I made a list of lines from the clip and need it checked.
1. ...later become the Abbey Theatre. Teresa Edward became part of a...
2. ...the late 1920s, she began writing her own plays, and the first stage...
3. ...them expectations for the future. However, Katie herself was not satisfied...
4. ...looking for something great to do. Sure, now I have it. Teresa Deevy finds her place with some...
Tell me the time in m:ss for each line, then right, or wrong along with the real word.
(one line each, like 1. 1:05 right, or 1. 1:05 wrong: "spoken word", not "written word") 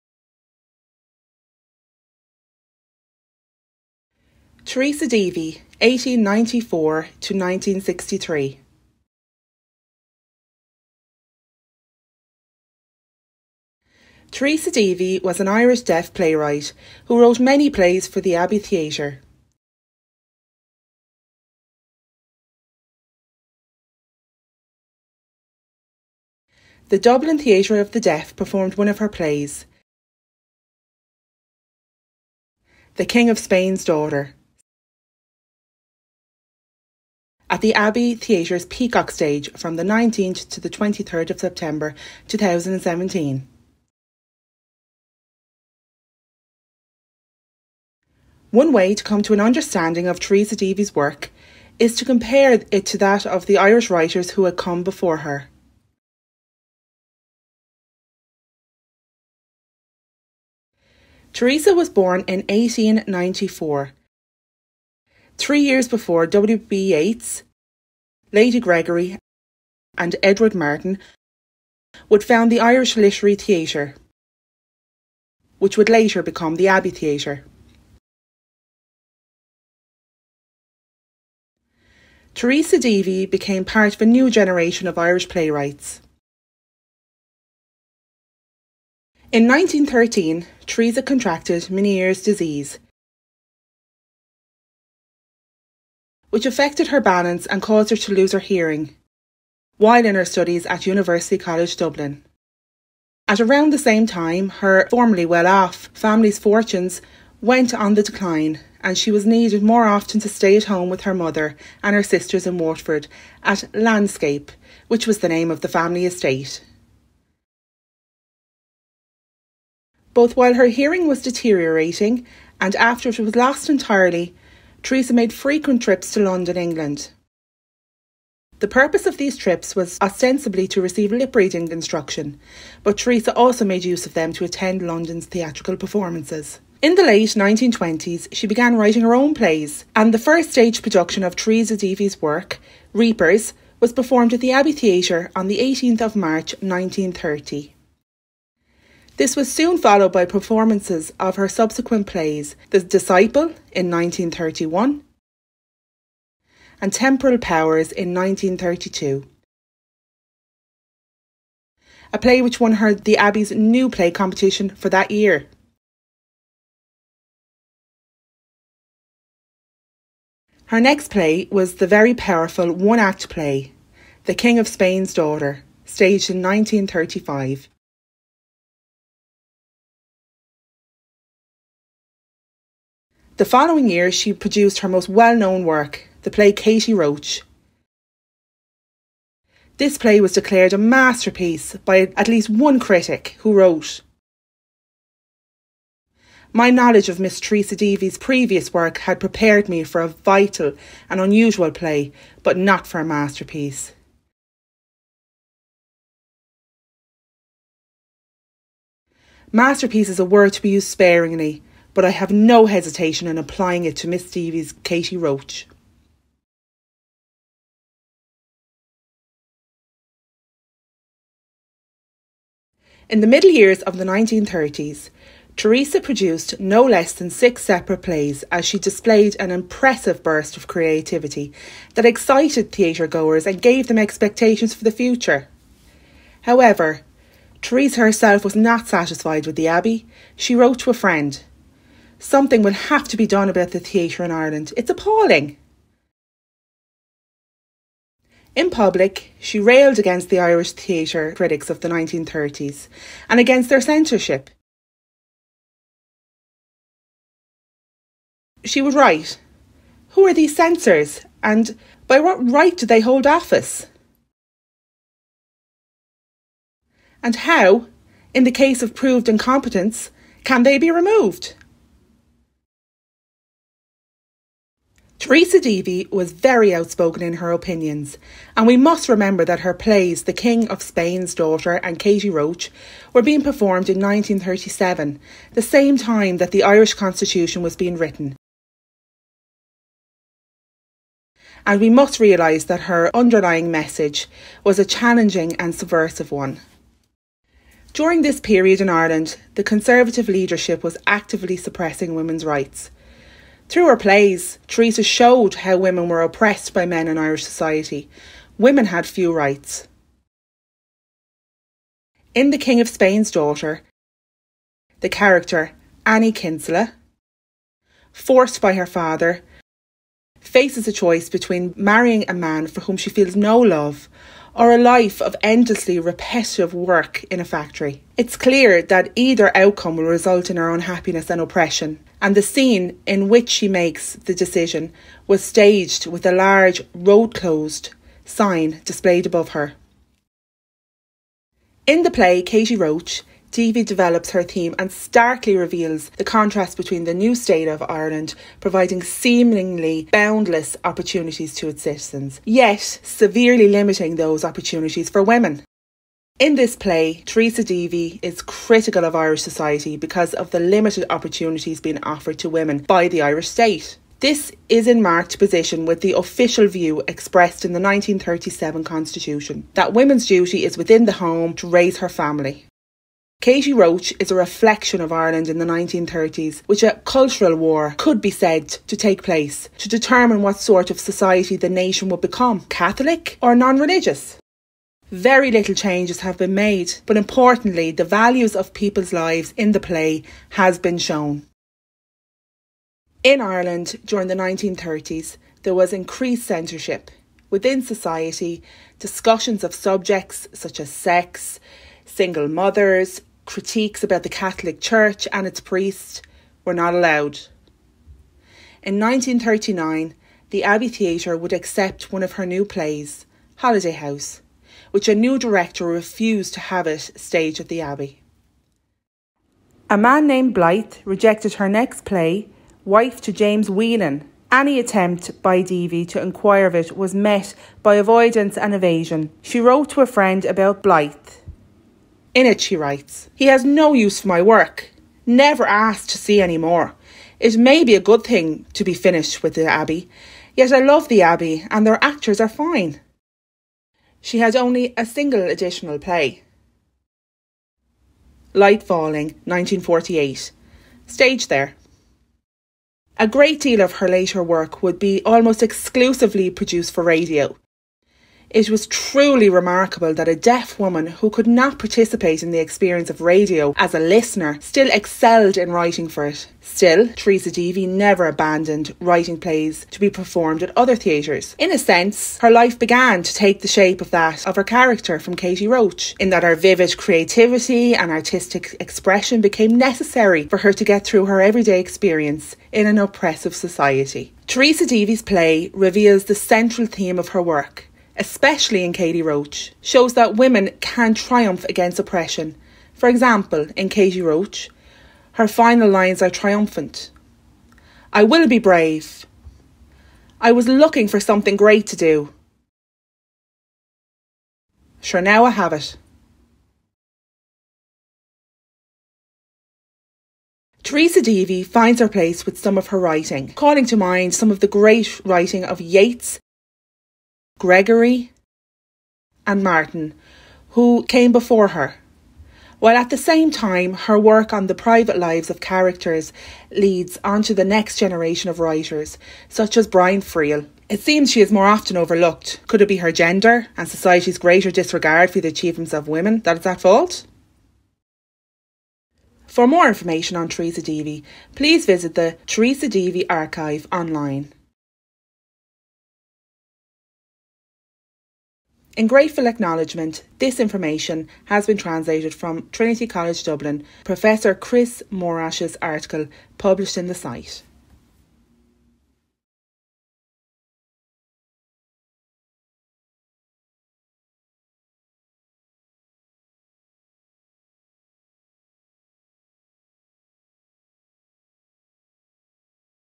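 1. 1:15 wrong: "Deevy", not "Edward"
2. 2:16 right
3. 3:53 wrong: "Teresa", not "Katie"
4. 8:20 right.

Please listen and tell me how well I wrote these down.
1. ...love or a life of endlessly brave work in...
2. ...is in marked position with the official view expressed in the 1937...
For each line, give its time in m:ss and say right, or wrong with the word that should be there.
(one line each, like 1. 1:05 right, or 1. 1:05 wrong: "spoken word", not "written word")
1. 5:23 wrong: "repetitive", not "brave"
2. 6:04 right.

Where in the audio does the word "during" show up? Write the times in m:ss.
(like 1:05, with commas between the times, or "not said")
4:57, 6:34.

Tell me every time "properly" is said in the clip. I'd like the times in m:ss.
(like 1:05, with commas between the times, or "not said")
not said.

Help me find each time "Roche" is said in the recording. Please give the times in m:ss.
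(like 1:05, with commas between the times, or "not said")
3:06, 3:35, 4:42, 5:42, 6:13, 7:55, 8:09, 8:14.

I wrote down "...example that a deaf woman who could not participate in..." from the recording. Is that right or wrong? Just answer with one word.
wrong.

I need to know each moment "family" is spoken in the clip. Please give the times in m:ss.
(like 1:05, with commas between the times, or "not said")
1:45, 1:55, 6:12.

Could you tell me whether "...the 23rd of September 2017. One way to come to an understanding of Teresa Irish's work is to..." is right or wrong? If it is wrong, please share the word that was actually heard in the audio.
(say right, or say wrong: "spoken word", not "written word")
wrong: "Deevy", not "Irish".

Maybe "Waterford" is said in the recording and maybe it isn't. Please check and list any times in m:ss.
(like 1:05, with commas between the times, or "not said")
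1:52.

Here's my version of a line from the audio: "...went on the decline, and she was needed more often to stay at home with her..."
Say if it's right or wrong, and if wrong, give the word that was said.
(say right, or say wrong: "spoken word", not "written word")
right.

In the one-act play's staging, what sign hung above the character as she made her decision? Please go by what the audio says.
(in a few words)
road closed.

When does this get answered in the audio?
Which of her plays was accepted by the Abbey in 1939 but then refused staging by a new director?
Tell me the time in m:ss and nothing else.
6:53.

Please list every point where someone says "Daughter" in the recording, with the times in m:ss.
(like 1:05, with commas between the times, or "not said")
0:33, 2:55, 4:41, 5:13.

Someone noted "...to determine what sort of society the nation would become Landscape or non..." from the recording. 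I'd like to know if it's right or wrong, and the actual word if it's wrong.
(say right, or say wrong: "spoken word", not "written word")
wrong: "Catholic", not "Landscape".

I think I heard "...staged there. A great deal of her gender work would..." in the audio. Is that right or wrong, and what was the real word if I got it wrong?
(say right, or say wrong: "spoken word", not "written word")
wrong: "later", not "gender".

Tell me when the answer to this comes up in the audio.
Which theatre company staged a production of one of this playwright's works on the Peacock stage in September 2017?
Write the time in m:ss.
0:26.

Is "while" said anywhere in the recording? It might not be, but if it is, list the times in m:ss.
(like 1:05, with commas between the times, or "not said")
1:39, 2:00, 8:42.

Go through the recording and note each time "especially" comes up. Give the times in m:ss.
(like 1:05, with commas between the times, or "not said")
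8:08.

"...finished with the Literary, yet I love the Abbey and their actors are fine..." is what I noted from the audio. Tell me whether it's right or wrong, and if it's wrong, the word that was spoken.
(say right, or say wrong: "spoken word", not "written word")
wrong: "Abbey", not "Literary".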